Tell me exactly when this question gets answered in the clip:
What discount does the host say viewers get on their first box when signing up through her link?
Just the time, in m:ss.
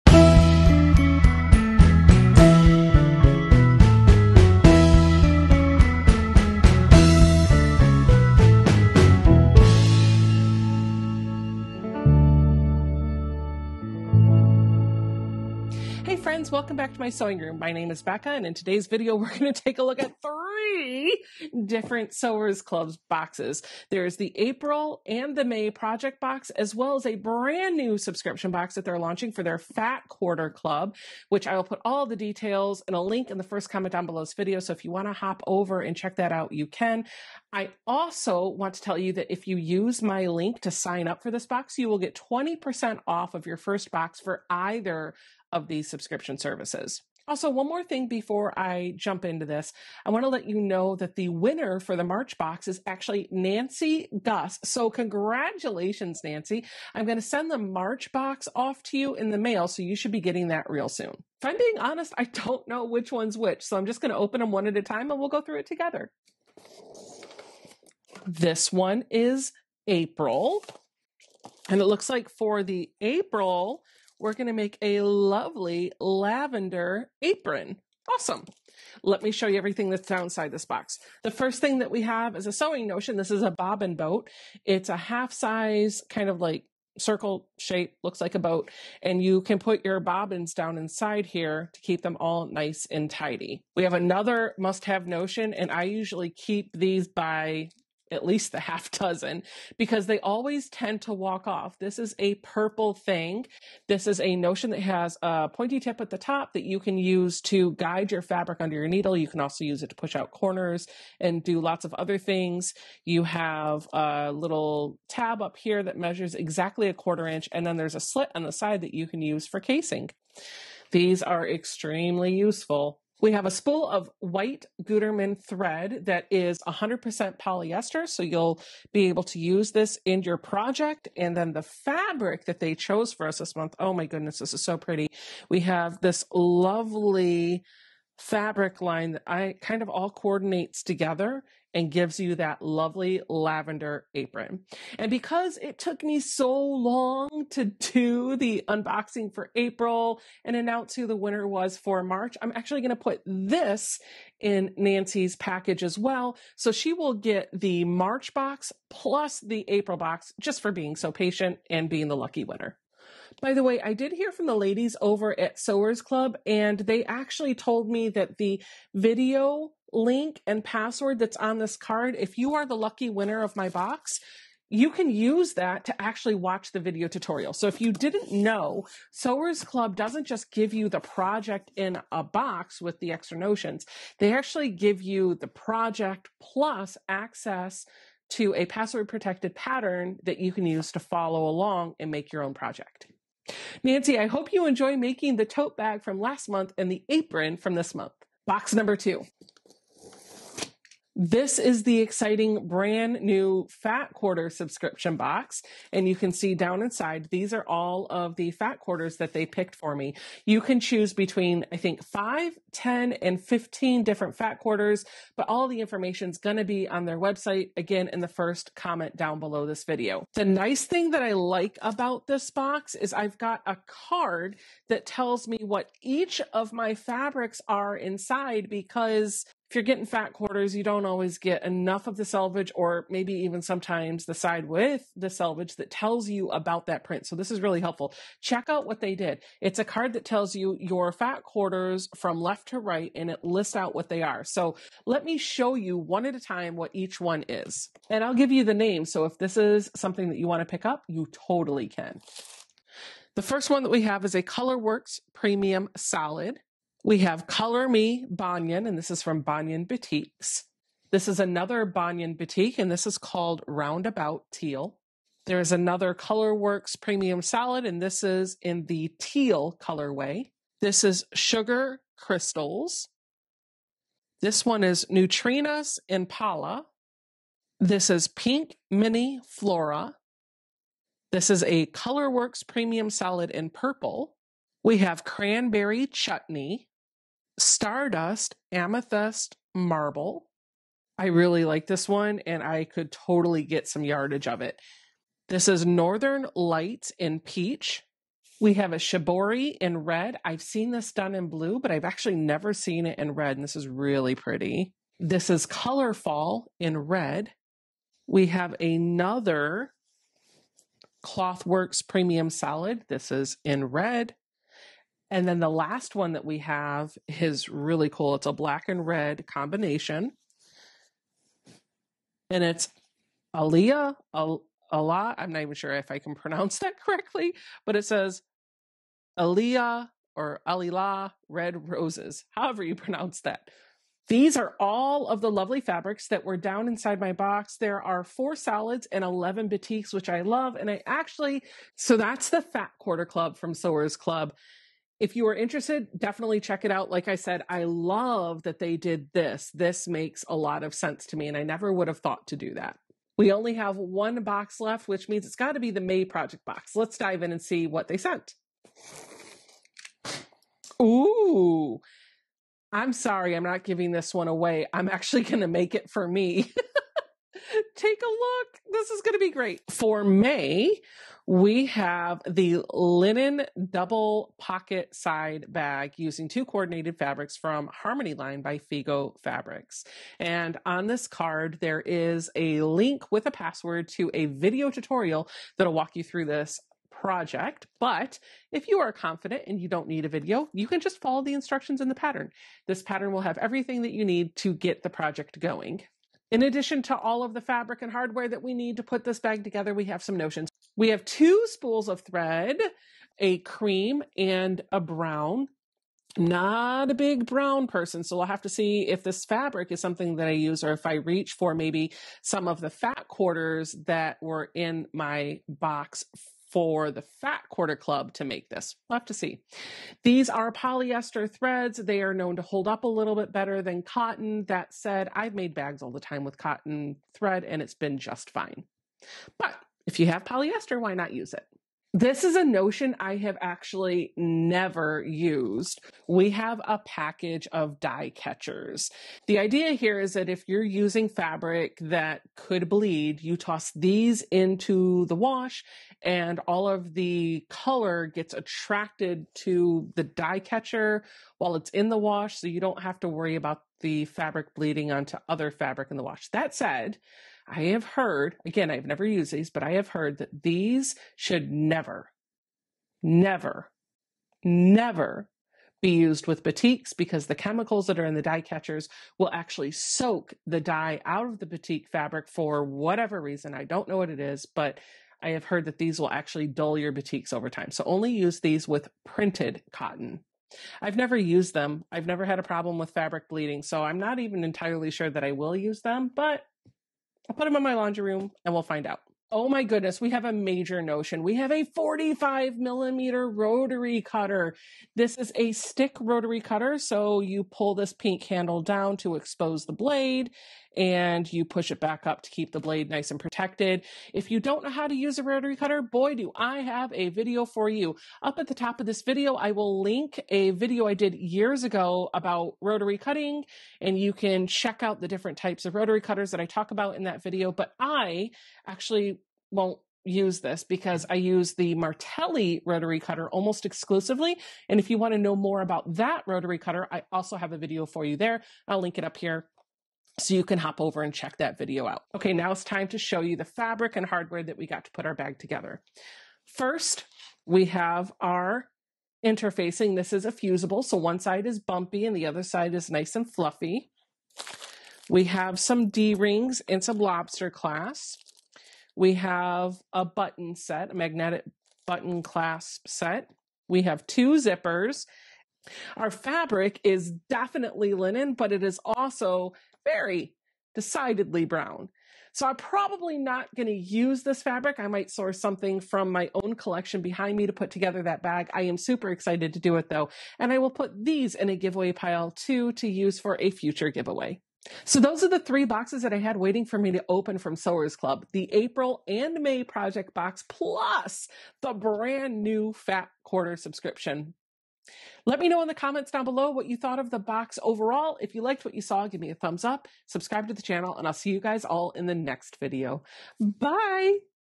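0:42.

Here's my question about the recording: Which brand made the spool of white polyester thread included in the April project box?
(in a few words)
Gutermann.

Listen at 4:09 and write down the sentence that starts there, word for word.
So if this is something that you want to pick up, you totally can.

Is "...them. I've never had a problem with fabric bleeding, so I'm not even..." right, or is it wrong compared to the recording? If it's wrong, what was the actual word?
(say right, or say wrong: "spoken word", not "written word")
right.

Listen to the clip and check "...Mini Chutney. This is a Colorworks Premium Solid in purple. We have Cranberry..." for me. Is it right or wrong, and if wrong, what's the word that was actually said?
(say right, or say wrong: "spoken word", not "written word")
wrong: "Flora", not "Chutney".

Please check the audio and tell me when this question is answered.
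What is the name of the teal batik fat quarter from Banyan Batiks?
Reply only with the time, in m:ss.
4:23.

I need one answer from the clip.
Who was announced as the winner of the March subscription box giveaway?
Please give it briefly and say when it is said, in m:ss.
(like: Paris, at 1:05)
Nancy Gus, at 0:53.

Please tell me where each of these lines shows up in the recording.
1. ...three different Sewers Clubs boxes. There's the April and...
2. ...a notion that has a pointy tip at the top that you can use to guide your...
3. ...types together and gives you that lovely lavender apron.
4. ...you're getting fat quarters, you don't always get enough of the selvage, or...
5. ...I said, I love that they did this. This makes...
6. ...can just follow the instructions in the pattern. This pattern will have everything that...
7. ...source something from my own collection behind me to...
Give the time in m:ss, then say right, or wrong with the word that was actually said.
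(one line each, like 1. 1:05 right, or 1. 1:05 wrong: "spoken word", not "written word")
1. 0:20 right
2. 1:44 right
3. 2:20 wrong: "coordinates", not "types"
4. 3:49 right
5. 5:47 right
6. 6:30 right
7. 9:25 right.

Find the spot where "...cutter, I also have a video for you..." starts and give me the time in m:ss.
8:46.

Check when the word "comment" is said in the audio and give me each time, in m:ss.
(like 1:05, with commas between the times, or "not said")
0:33, 3:38, 9:45.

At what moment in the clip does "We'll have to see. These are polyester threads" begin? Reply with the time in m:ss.
6:59.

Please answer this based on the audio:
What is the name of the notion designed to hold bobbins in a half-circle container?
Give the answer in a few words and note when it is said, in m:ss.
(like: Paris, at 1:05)
bobbin boat, at 1:23.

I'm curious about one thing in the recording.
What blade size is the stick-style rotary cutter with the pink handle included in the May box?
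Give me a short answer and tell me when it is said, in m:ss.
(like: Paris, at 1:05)
45 millimeter, at 8:11.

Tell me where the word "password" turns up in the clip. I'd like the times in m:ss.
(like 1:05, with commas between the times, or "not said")
2:50, 3:08, 6:23.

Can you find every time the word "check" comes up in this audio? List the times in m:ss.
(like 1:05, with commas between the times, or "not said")
0:35, 3:58, 5:46, 8:34, 8:51.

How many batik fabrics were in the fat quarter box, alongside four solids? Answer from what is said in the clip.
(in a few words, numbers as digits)
11.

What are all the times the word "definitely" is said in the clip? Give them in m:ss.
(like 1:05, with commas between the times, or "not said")
5:46, 9:17.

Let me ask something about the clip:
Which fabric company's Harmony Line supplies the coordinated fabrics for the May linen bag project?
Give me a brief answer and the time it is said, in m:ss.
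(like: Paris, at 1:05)
Figo Fabrics, at 6:18.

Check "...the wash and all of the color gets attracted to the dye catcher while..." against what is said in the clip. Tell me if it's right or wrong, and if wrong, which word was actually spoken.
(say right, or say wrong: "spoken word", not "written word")
right.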